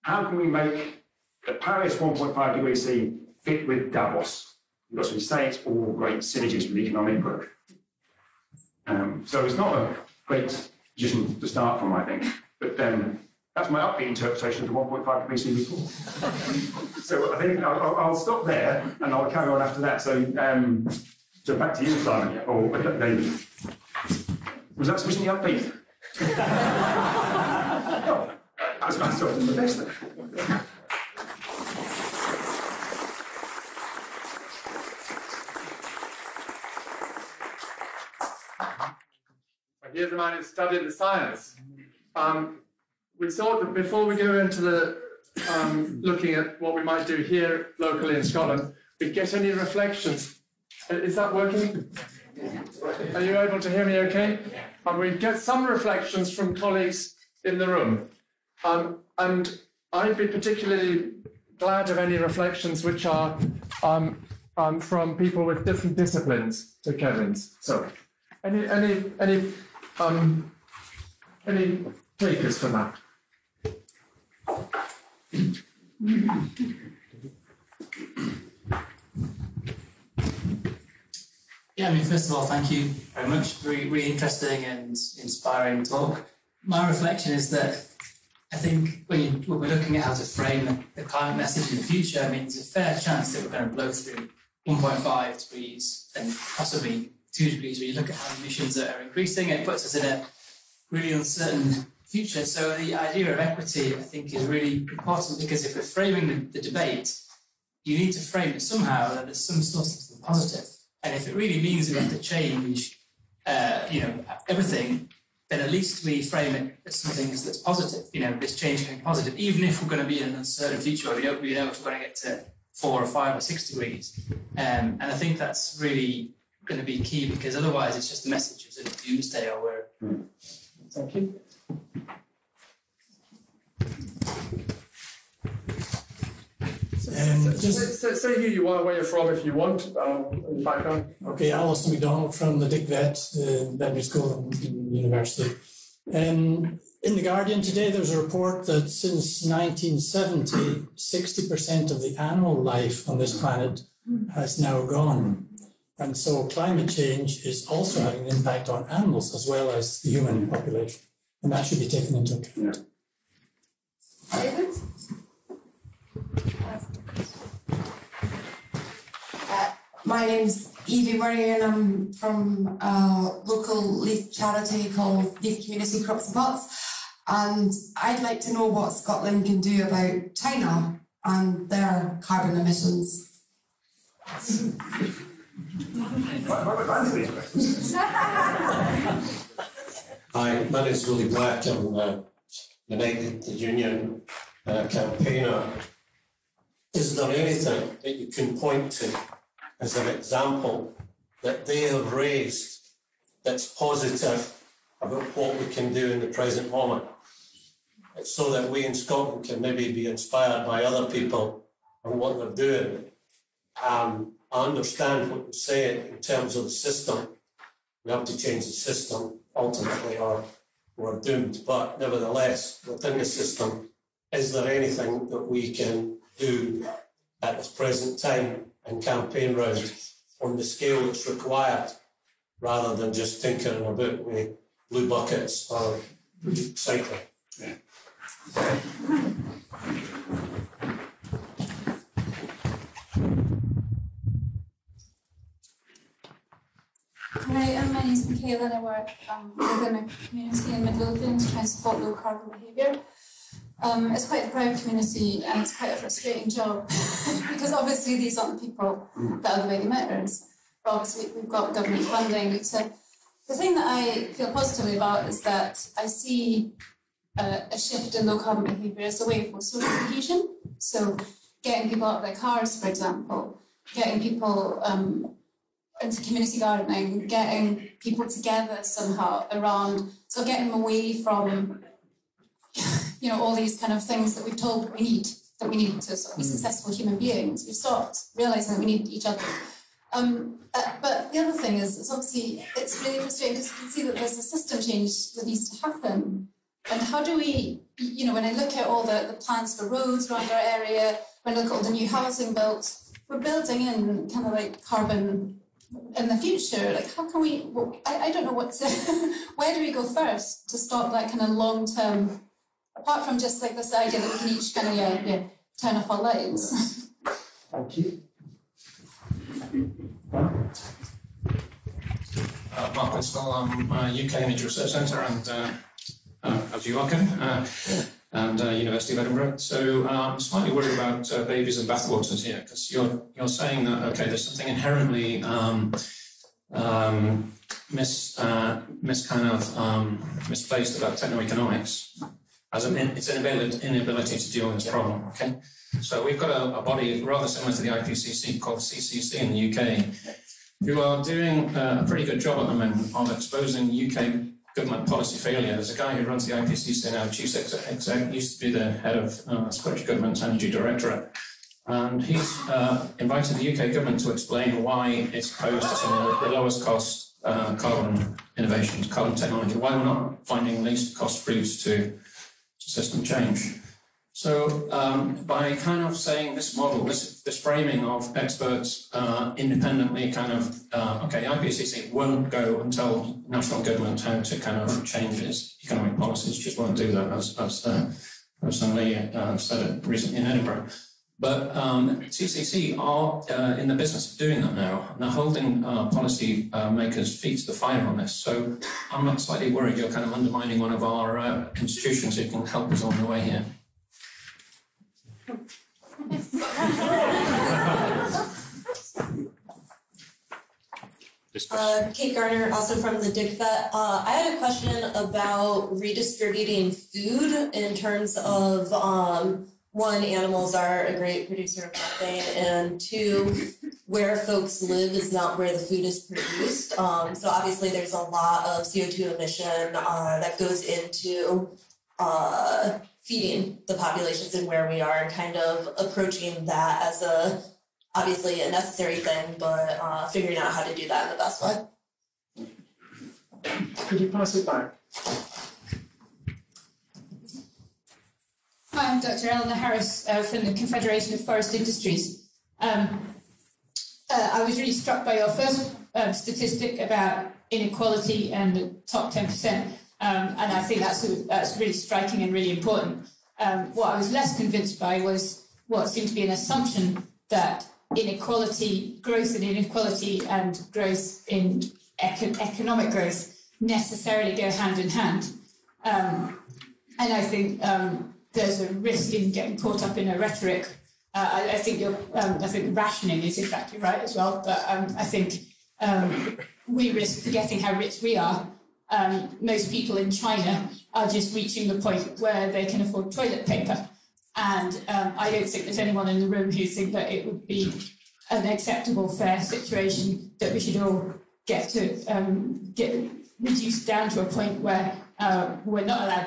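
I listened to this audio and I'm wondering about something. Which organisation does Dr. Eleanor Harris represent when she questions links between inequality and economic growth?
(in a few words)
Confederation of Forest Industries.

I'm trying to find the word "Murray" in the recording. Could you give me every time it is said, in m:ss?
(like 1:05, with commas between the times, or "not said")
2:51.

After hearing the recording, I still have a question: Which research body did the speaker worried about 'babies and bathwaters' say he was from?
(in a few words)
UK Energy Research Centre.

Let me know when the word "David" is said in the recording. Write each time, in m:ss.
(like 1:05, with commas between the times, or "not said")
0:22, 2:44.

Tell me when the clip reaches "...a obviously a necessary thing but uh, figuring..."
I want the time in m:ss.
7:17.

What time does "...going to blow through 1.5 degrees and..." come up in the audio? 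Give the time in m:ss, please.
1:33.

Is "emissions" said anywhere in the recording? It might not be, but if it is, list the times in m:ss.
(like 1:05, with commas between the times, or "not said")
1:38, 3:02, 7:09.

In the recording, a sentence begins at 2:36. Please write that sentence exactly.
And so climate change is also having an impact on animals as well as the human population.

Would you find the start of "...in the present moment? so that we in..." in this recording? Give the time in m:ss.
3:26.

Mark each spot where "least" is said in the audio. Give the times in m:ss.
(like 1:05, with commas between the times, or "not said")
1:55, 6:10.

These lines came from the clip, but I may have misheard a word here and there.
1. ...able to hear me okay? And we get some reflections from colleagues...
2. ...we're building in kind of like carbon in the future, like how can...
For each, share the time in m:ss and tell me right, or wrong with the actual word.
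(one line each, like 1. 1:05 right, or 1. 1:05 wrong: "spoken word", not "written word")
1. 0:53 right
2. 5:03 right.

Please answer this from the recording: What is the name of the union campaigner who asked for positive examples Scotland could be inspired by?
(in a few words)
Willie Black.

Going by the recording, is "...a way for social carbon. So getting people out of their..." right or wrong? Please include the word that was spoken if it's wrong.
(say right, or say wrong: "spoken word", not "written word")
wrong: "cohesion", not "carbon".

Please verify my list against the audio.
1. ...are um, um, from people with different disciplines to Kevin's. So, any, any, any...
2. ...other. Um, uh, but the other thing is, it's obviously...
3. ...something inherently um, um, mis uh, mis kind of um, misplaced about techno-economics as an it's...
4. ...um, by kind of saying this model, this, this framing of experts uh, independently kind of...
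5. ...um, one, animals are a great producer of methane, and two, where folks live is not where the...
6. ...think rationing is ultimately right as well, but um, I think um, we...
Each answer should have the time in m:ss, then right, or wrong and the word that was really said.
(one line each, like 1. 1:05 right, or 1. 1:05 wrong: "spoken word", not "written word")
1. 1:03 right
2. 4:49 right
3. 5:34 right
4. 6:14 right
5. 6:58 right
6. 8:02 wrong: "exactly", not "ultimately".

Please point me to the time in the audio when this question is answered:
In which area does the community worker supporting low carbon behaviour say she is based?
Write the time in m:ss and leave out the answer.
4:10.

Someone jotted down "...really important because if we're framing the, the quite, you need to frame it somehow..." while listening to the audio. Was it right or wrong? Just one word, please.
wrong.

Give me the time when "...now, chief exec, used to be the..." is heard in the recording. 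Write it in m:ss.
5:57.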